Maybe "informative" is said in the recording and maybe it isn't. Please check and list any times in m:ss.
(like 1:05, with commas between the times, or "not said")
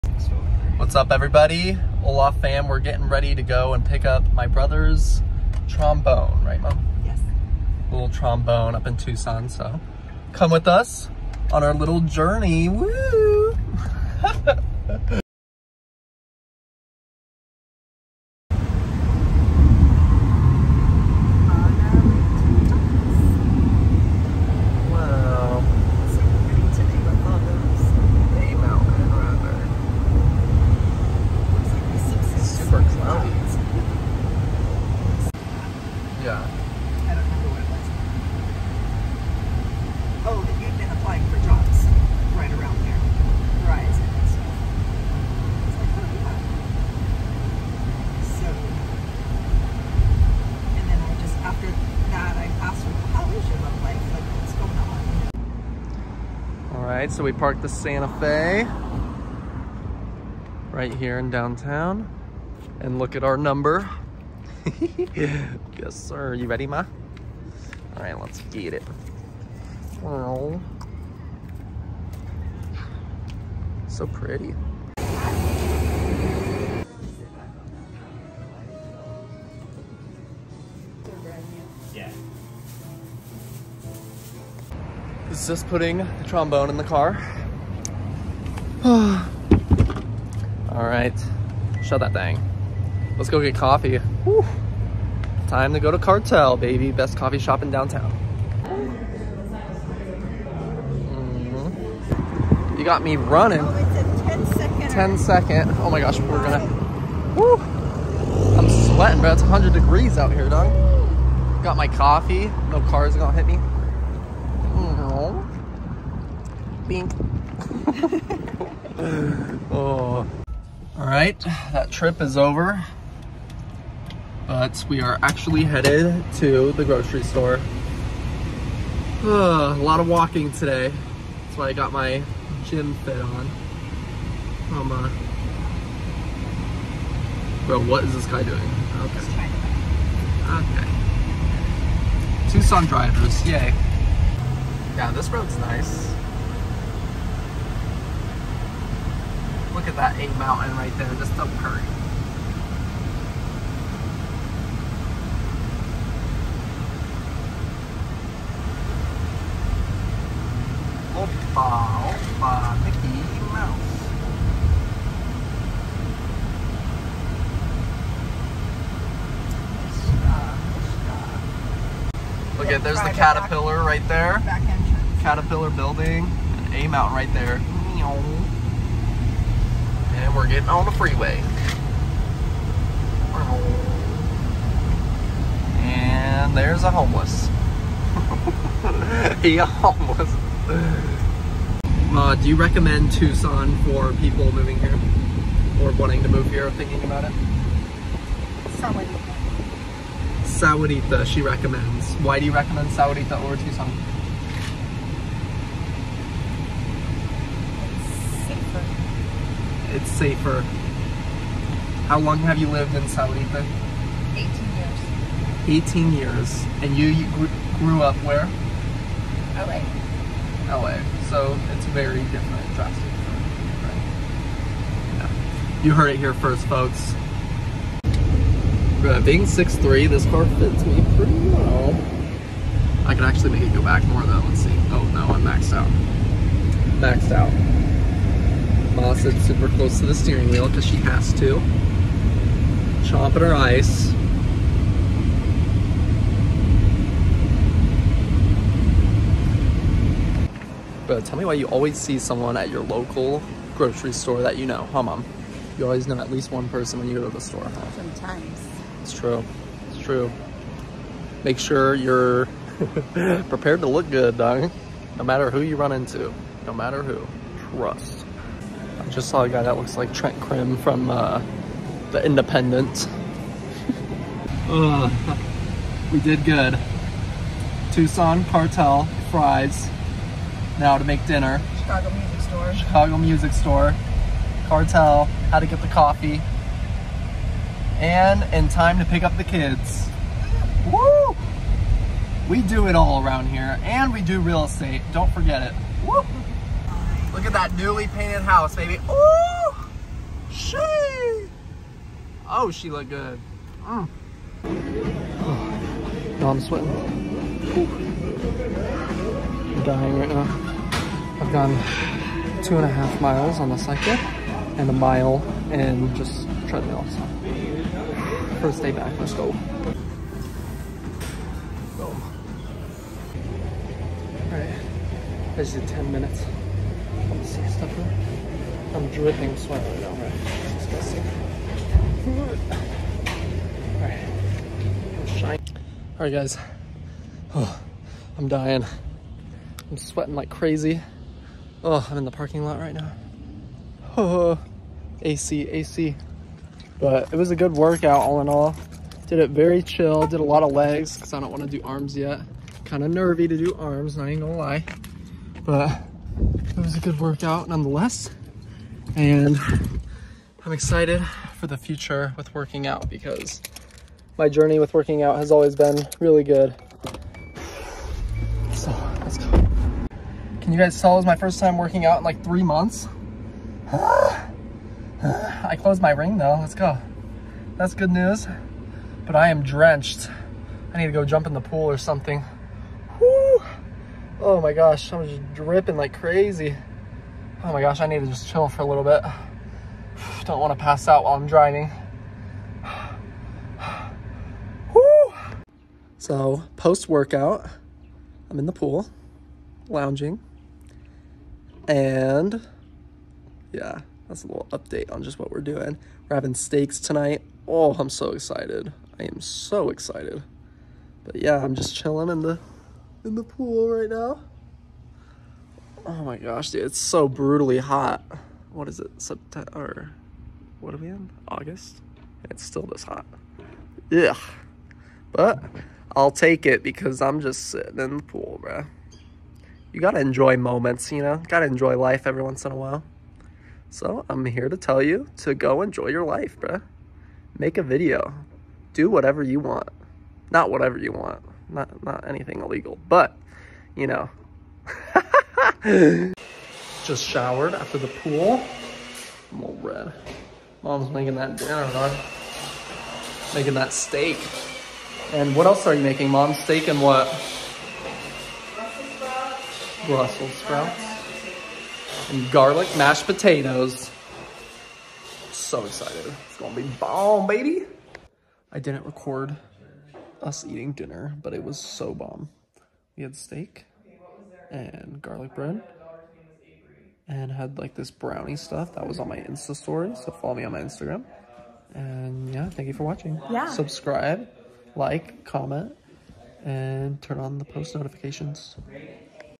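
not said.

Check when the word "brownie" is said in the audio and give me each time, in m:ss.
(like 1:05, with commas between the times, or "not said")
7:58.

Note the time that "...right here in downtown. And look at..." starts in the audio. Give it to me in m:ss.
1:00.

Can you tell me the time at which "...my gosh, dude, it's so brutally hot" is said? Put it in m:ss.
6:56.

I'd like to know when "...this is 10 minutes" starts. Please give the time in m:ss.
5:25.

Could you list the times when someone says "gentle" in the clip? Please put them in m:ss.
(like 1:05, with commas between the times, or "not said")
not said.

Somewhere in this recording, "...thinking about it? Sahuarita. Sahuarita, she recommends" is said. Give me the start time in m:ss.
3:16.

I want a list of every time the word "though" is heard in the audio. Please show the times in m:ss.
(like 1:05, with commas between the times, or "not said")
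3:54, 6:16.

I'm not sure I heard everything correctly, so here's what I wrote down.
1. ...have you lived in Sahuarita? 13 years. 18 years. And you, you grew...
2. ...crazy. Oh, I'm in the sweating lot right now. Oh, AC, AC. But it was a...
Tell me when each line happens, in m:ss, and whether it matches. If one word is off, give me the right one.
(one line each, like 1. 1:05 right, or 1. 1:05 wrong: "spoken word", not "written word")
1. 3:32 wrong: "18", not "13"
2. 5:40 wrong: "parking", not "sweating".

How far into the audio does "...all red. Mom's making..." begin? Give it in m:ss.
7:29.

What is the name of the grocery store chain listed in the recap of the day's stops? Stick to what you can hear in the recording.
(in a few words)
Fry's.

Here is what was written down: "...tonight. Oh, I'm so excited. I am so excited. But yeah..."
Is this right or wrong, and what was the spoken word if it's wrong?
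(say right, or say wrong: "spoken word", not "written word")
right.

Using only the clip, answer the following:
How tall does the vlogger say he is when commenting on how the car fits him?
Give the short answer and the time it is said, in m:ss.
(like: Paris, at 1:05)
6'3", at 3:49.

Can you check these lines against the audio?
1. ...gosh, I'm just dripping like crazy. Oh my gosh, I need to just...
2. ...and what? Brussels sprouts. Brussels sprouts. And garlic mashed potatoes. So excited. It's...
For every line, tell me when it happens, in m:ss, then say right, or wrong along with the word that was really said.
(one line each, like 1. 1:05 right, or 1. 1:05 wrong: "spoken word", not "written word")
1. 6:24 right
2. 7:36 right.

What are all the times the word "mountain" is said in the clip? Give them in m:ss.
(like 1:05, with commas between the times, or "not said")
2:30, 2:56.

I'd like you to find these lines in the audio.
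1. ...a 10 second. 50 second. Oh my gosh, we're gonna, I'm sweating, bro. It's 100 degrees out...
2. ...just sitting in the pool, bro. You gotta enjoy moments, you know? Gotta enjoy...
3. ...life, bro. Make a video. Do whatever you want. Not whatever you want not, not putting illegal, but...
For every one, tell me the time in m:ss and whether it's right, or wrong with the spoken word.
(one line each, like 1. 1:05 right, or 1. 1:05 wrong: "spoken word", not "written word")
1. 1:44 wrong: "10", not "50"
2. 7:07 right
3. 7:16 wrong: "anything", not "putting".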